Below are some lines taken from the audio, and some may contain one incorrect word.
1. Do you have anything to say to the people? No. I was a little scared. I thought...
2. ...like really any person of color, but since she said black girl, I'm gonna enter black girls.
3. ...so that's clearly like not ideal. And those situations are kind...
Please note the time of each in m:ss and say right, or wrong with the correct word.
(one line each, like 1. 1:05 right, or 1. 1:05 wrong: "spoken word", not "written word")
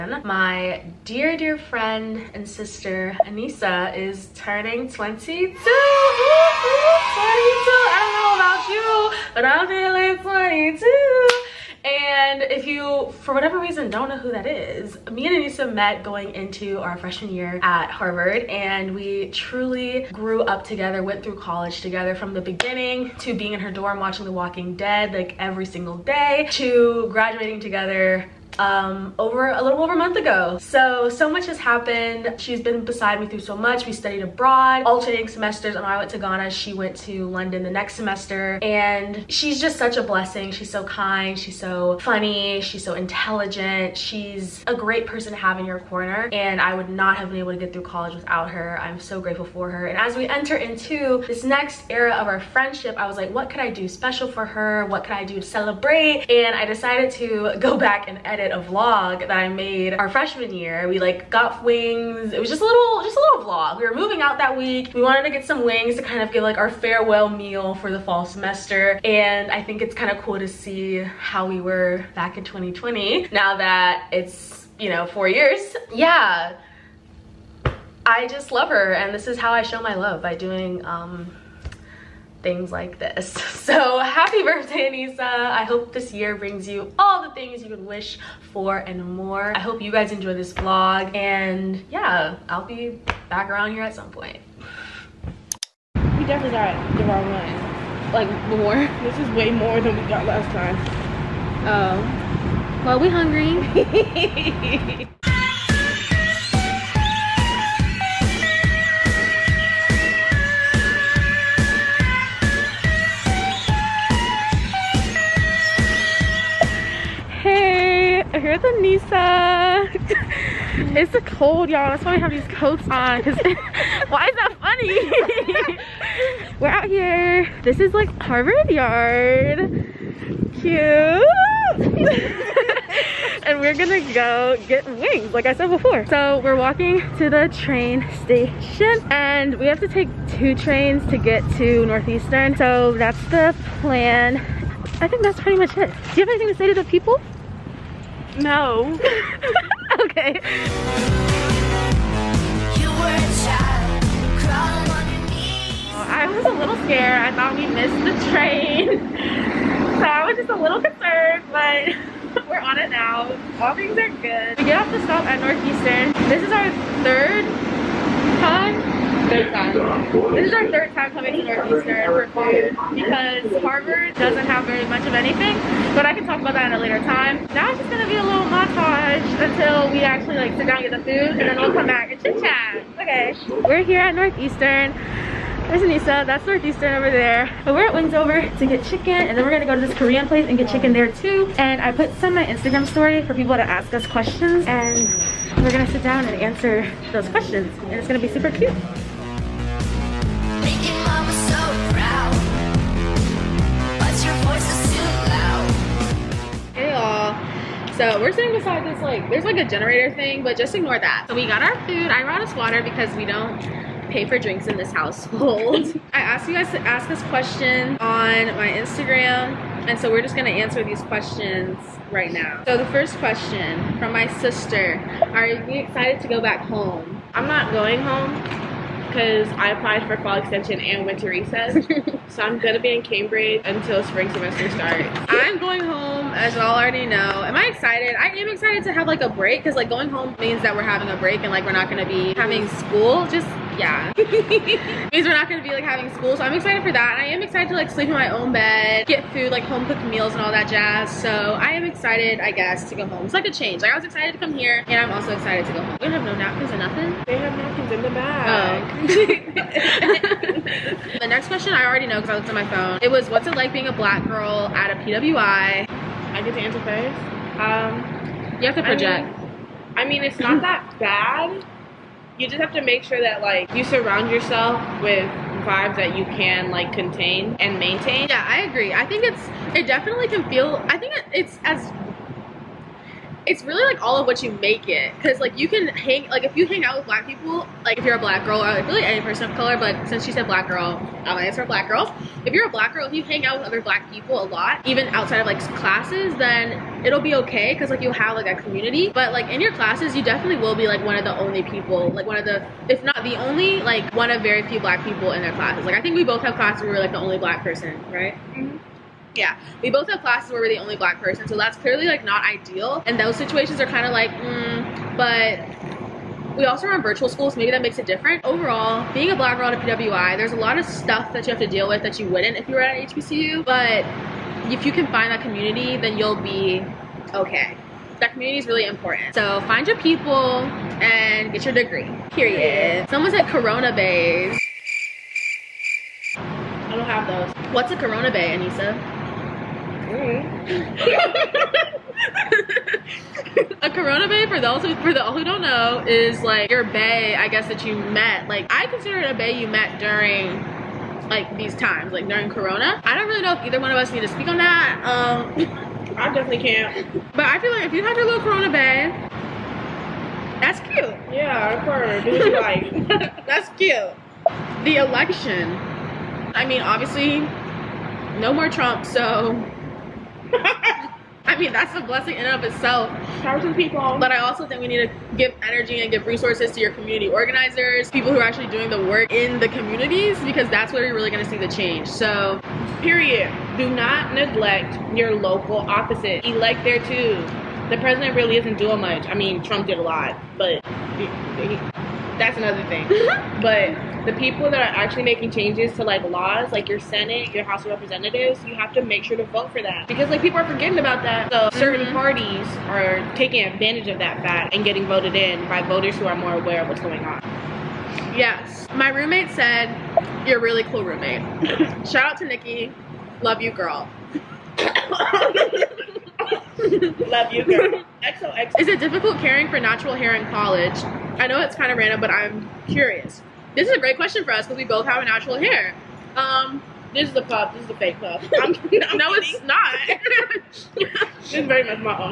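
1. 2:25 right
2. 4:48 wrong: "answer", not "enter"
3. 5:11 right.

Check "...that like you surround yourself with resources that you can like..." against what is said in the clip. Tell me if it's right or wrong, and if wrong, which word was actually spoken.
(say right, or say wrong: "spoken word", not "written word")
wrong: "vibes", not "resources".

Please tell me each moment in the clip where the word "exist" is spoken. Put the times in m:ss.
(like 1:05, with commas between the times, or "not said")
not said.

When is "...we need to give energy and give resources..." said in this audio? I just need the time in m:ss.
6:14.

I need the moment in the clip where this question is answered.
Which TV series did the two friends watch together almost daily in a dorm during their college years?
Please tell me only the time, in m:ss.
0:24.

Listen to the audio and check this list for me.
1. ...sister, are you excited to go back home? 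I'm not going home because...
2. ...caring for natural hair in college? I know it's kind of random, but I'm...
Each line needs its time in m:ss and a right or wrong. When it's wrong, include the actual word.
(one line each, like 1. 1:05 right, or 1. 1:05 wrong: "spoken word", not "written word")
1. 3:44 right
2. 6:59 right.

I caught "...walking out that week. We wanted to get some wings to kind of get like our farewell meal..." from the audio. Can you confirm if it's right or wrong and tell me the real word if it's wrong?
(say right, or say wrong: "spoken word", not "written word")
wrong: "moving", not "walking".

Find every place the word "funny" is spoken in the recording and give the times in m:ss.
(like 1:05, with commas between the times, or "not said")
0:42, 2:04.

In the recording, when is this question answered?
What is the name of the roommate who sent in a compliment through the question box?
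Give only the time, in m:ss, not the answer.
6:52.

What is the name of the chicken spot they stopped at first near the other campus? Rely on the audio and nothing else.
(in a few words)
Wingsover.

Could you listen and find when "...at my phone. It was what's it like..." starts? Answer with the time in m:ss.
4:22.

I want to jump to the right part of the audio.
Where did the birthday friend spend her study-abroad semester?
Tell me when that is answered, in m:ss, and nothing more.
0:37.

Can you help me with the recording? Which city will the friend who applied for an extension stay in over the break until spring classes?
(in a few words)
Cambridge.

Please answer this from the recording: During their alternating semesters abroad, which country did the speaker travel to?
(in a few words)
Ghana.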